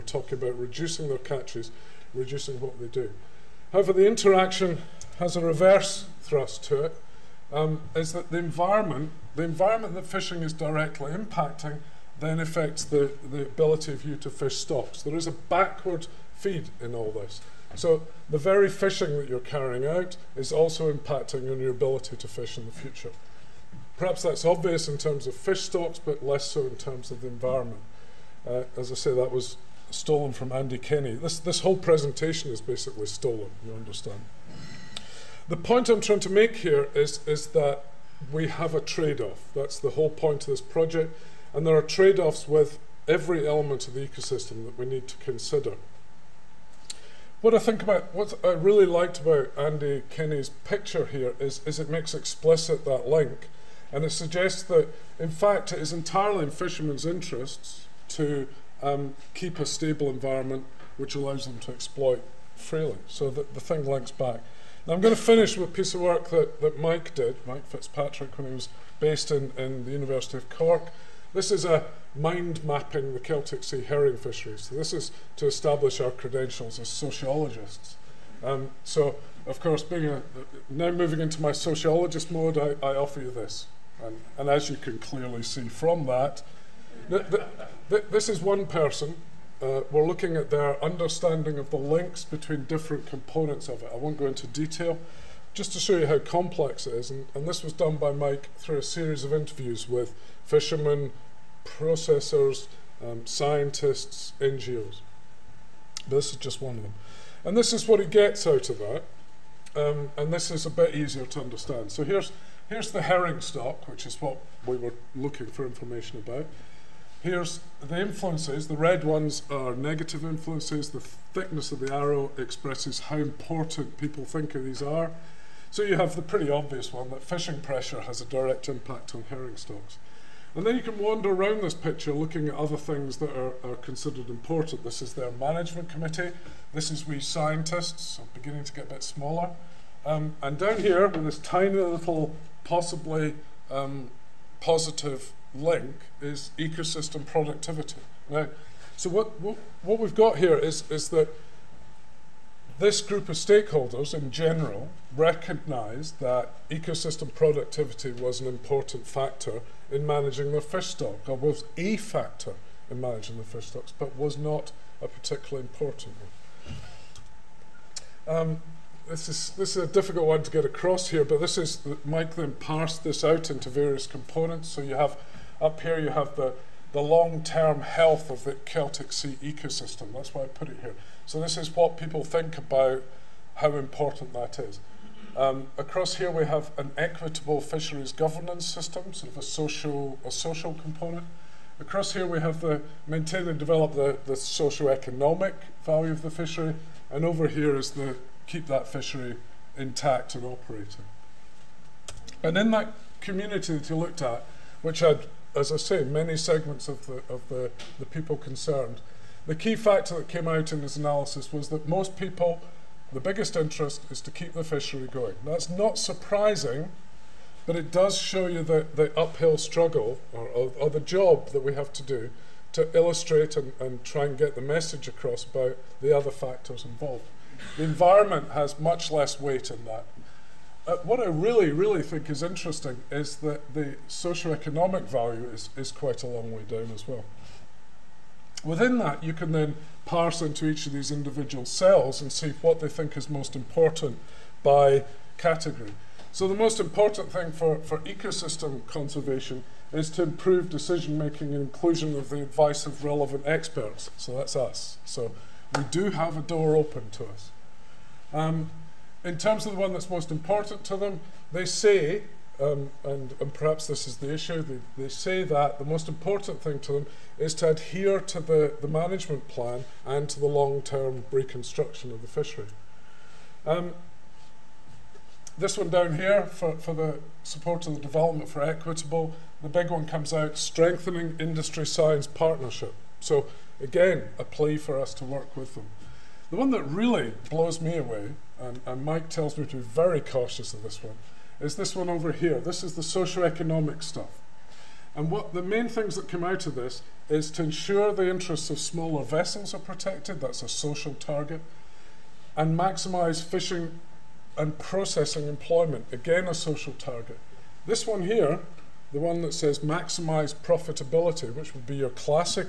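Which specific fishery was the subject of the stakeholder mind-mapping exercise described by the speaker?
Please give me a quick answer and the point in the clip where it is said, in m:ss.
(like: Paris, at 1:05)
Celtic Sea herring, at 1:13.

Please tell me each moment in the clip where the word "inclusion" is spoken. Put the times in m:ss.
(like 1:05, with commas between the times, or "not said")
4:11.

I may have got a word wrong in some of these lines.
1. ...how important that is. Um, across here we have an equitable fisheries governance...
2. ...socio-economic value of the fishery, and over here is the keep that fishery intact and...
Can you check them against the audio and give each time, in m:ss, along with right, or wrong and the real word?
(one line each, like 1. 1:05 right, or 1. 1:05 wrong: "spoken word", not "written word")
1. 3:03 right
2. 3:14 right.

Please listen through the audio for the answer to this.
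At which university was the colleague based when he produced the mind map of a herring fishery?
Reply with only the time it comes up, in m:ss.
1:09.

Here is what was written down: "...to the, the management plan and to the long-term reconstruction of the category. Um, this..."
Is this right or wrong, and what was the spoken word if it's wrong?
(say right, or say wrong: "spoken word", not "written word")
wrong: "fishery", not "category".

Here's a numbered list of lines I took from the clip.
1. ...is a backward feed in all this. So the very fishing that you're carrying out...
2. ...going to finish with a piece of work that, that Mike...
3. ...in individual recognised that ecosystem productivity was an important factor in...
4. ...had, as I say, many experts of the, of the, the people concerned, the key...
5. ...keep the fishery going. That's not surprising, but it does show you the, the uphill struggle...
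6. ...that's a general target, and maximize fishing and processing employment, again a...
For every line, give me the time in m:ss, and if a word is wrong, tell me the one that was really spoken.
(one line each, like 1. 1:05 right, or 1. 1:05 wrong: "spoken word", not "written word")
1. 0:15 right
2. 1:04 right
3. 2:34 wrong: "general", not "individual"
4. 3:24 wrong: "segments", not "experts"
5. 3:34 right
6. 5:00 wrong: "social", not "general".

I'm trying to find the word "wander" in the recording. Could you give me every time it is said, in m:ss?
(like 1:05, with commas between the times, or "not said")
2:10.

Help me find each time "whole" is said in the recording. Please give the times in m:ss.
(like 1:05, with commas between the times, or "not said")
0:31, 0:39.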